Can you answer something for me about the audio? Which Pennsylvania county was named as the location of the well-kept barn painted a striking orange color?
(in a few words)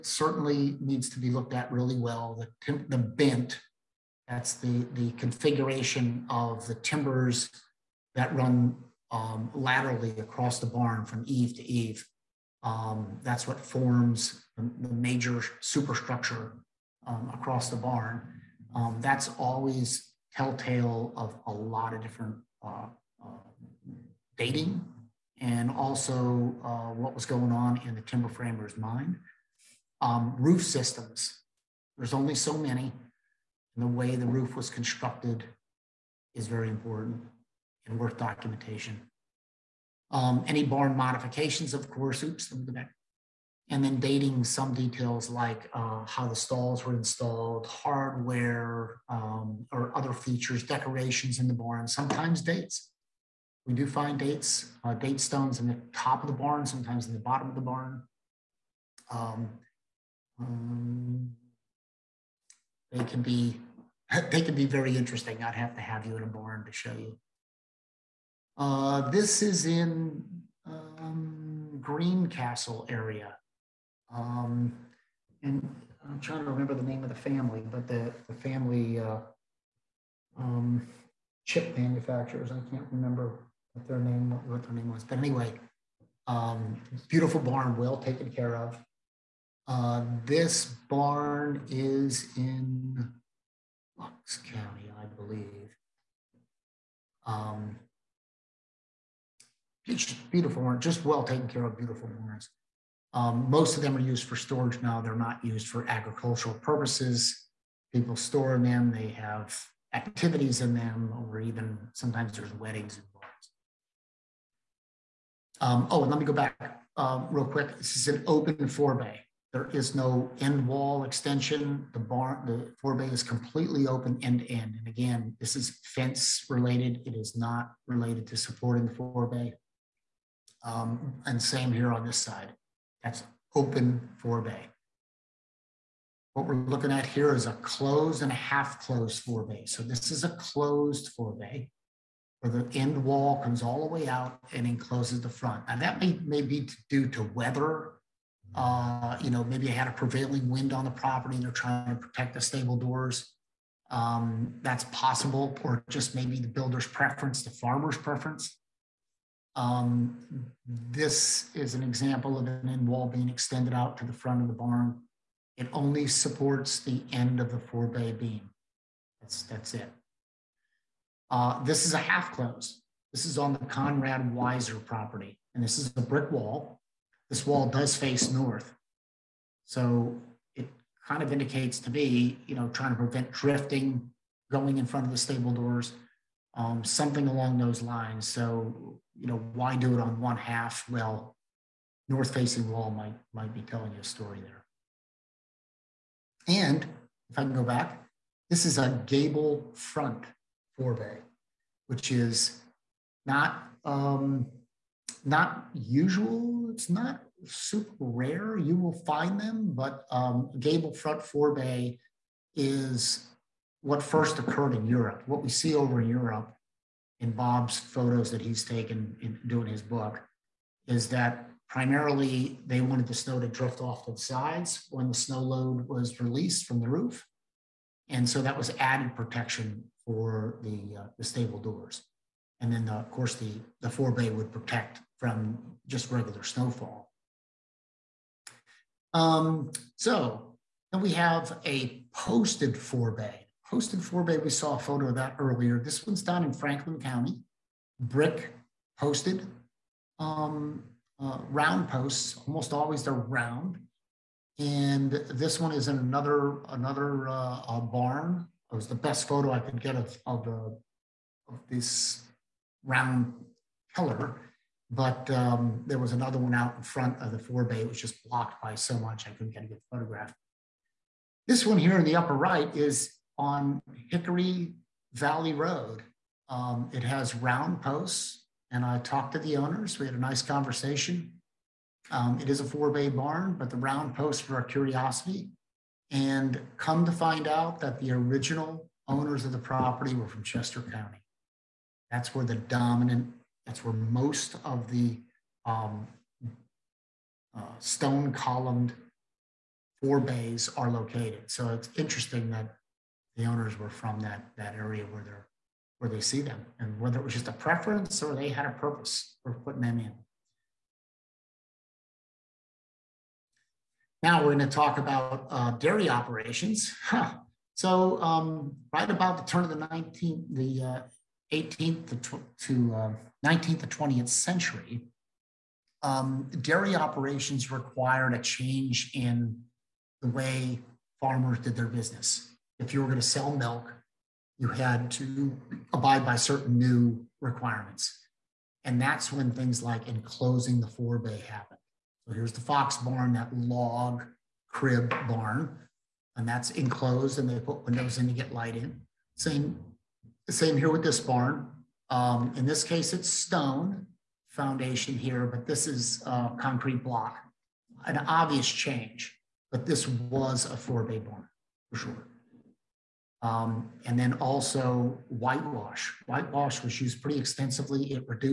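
Bucks County.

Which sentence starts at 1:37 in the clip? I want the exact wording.
Um, beautiful orange, just well taken care of, beautiful orange.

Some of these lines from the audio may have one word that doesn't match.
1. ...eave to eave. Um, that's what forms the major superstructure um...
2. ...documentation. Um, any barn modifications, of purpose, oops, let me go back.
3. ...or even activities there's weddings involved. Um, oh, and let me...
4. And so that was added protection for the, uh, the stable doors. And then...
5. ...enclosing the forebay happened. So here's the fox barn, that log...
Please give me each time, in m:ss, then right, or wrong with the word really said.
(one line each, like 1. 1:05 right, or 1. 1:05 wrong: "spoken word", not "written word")
1. 0:11 right
2. 0:38 wrong: "course", not "purpose"
3. 1:51 wrong: "sometimes", not "activities"
4. 3:48 right
5. 5:40 right.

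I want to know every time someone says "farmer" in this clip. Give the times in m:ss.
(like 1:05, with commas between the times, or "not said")
2:37, 5:31.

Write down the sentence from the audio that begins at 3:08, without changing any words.
So you know, why do it on one half?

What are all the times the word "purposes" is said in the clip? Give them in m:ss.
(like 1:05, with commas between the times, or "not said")
1:46, 5:08.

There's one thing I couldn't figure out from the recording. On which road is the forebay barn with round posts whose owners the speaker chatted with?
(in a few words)
Hickory Valley Road.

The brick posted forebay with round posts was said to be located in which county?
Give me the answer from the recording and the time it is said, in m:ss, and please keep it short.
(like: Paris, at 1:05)
Franklin County, at 4:06.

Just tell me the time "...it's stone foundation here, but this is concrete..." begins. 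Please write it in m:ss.
5:53.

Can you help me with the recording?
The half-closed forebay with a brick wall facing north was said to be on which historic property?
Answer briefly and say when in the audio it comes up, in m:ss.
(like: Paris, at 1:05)
Conrad Weiser property, at 2:53.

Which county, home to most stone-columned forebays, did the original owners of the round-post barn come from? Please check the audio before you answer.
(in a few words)
Chester County.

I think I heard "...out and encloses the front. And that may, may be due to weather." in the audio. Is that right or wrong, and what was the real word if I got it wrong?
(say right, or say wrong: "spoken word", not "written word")
right.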